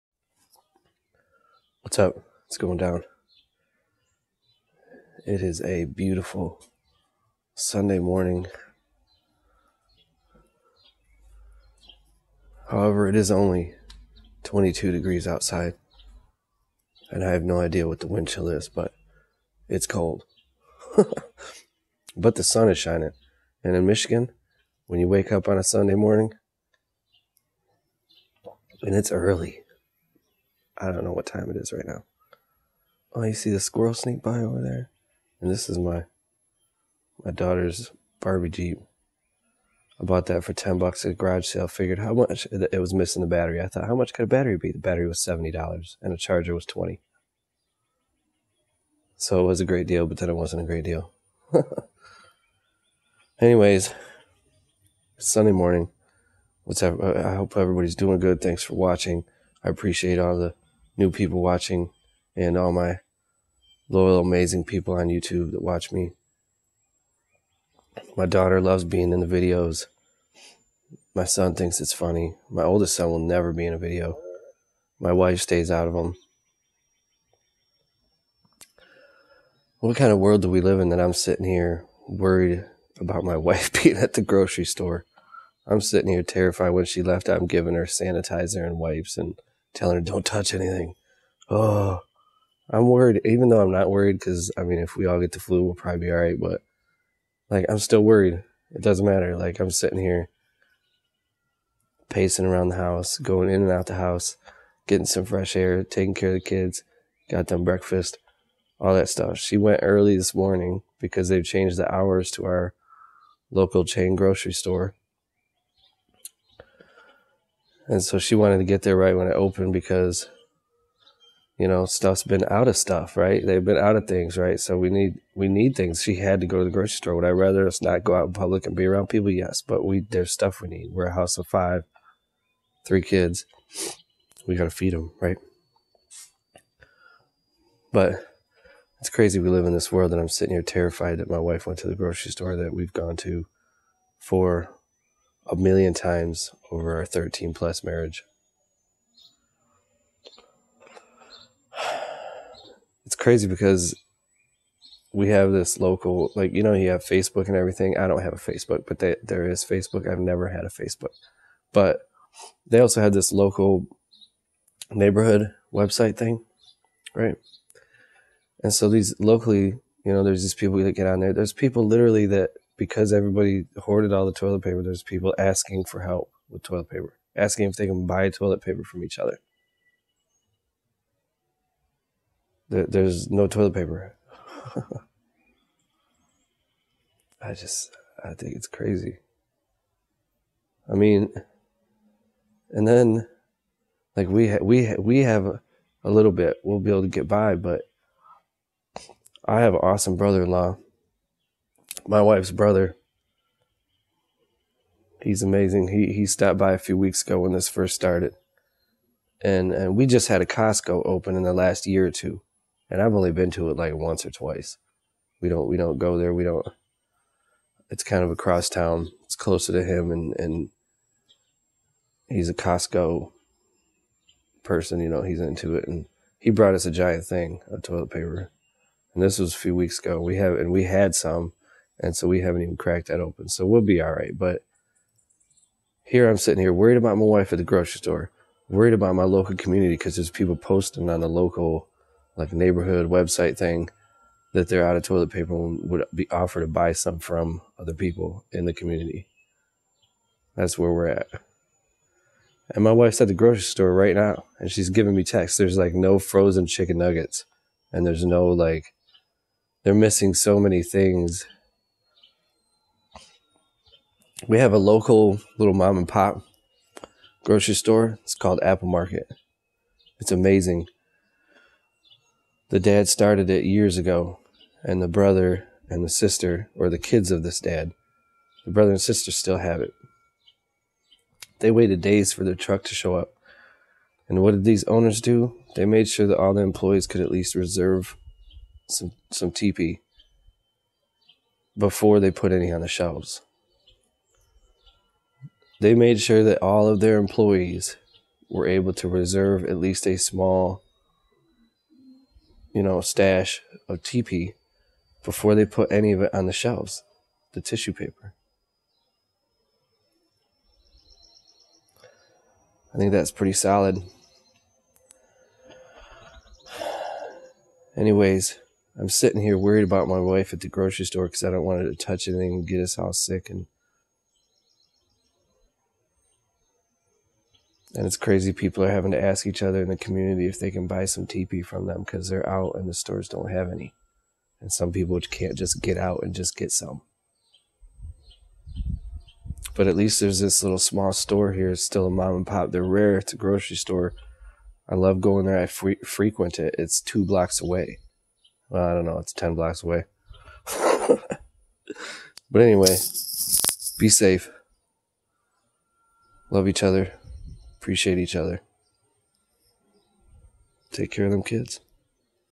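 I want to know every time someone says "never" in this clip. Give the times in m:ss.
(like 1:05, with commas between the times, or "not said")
1:13, 2:40.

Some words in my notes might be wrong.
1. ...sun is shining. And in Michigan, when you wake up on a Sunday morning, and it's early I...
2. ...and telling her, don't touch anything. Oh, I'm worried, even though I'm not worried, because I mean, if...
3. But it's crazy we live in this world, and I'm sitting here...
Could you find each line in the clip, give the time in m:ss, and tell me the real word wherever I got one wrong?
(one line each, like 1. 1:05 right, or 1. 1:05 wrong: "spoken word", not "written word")
1. 0:22 right
2. 1:29 right
3. 2:17 right.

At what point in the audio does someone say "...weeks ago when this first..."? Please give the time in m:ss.
3:26.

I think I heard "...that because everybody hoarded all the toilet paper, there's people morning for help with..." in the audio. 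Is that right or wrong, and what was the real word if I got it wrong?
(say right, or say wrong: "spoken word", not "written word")
wrong: "asking", not "morning".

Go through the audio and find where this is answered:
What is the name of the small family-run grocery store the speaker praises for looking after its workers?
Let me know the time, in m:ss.
4:28.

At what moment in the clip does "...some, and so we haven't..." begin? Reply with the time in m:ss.
3:51.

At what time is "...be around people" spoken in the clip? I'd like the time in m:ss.
2:08.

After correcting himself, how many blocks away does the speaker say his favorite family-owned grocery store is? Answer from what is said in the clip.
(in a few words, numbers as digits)
10.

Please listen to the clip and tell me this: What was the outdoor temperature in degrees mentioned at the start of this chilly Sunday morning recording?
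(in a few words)
22.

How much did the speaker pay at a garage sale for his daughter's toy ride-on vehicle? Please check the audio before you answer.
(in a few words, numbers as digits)
$10.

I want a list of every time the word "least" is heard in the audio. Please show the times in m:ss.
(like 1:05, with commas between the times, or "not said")
4:47, 4:59, 5:39.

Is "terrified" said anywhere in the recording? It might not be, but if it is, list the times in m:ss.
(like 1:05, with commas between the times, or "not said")
1:26, 2:20.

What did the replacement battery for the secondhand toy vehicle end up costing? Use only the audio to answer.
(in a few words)
$70.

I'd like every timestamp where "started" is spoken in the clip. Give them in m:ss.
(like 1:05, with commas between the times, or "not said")
3:27, 4:33.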